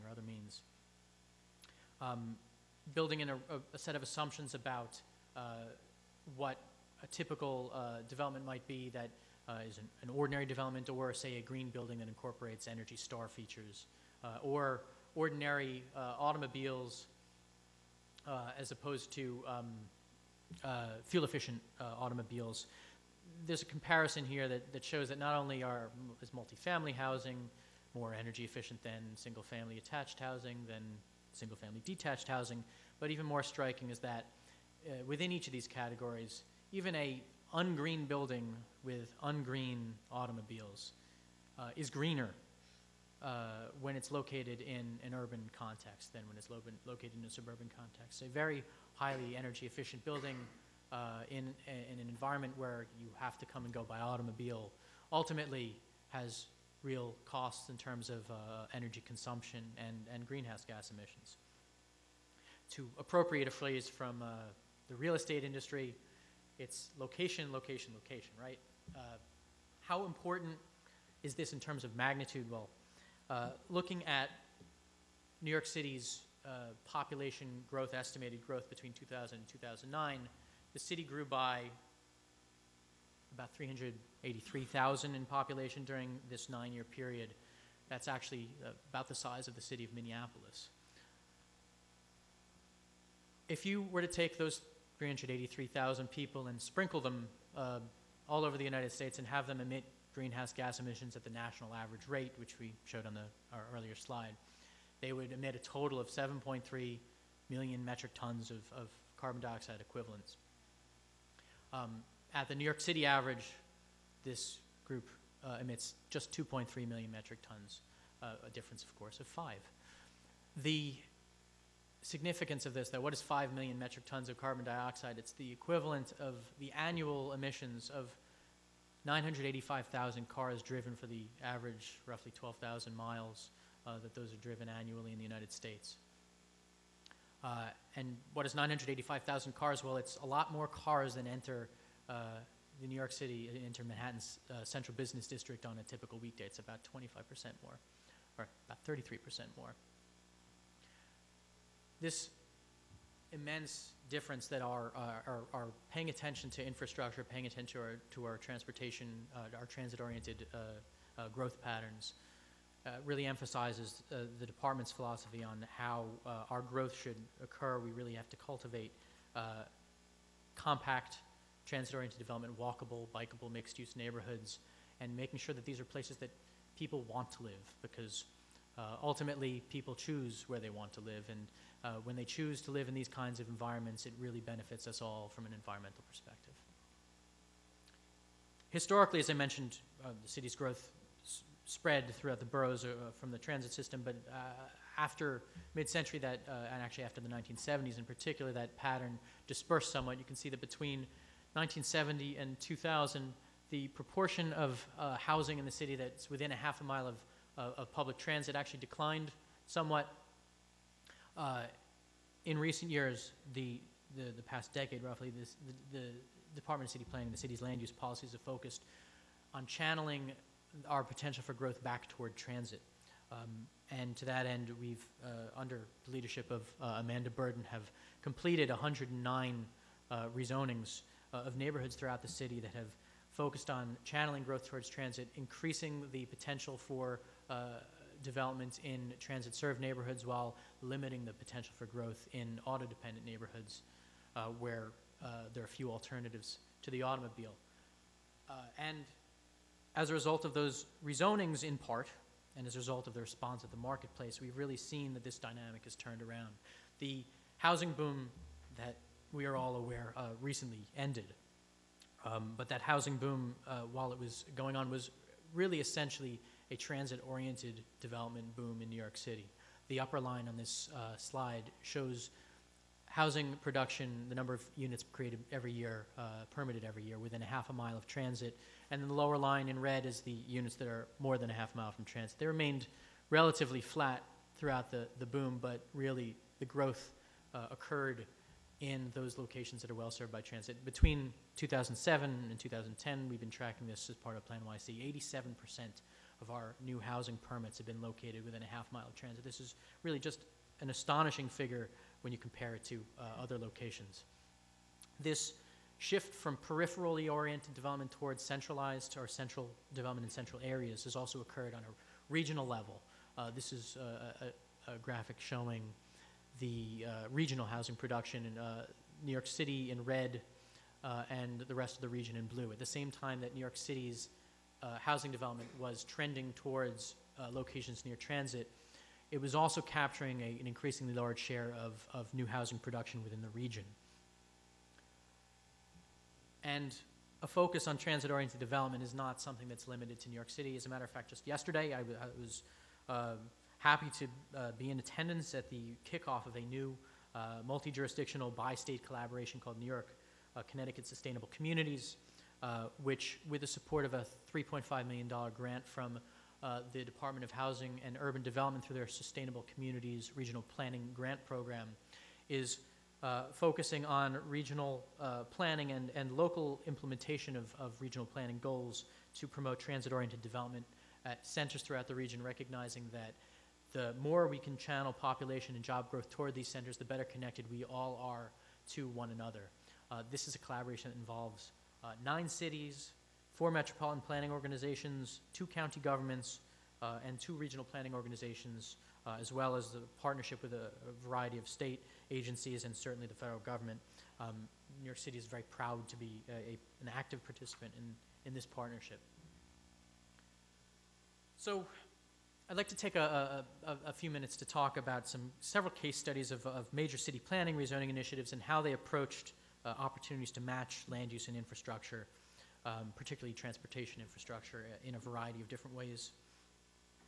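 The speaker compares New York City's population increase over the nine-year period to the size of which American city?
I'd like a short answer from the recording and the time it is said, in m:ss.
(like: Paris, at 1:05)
Minneapolis, at 1:29.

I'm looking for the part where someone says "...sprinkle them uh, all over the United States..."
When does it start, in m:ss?
1:36.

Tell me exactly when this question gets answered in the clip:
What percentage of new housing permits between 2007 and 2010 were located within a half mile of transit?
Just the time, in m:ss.
4:55.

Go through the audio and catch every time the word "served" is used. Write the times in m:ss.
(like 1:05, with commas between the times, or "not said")
3:59, 4:50.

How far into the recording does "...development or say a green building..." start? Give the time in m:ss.
0:10.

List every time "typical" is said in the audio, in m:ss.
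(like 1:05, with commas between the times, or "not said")
0:07, 2:25.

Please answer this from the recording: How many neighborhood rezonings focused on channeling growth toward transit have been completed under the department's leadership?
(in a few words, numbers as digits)
109.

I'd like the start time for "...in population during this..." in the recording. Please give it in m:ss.
1:25.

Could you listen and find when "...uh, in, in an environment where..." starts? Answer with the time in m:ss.
0:50.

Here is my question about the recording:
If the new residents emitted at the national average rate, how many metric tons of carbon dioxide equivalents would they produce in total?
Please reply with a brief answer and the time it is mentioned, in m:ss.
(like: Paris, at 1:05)
7.3 million, at 1:46.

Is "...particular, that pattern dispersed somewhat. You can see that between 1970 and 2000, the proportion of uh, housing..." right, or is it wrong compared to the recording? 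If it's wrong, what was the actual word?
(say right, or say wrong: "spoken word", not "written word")
right.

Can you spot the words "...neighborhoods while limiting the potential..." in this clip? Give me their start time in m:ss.
3:59.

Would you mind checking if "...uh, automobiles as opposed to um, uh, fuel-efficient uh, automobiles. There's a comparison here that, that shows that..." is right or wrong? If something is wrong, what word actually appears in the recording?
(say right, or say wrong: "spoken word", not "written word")
right.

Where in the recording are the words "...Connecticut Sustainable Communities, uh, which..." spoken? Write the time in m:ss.
5:50.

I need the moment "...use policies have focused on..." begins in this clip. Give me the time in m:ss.
3:37.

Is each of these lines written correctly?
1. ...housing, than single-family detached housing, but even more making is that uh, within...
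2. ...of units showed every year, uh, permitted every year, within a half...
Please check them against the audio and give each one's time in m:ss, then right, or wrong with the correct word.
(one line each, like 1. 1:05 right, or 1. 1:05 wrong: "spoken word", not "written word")
1. 0:30 wrong: "striking", not "making"
2. 4:34 wrong: "created", not "showed".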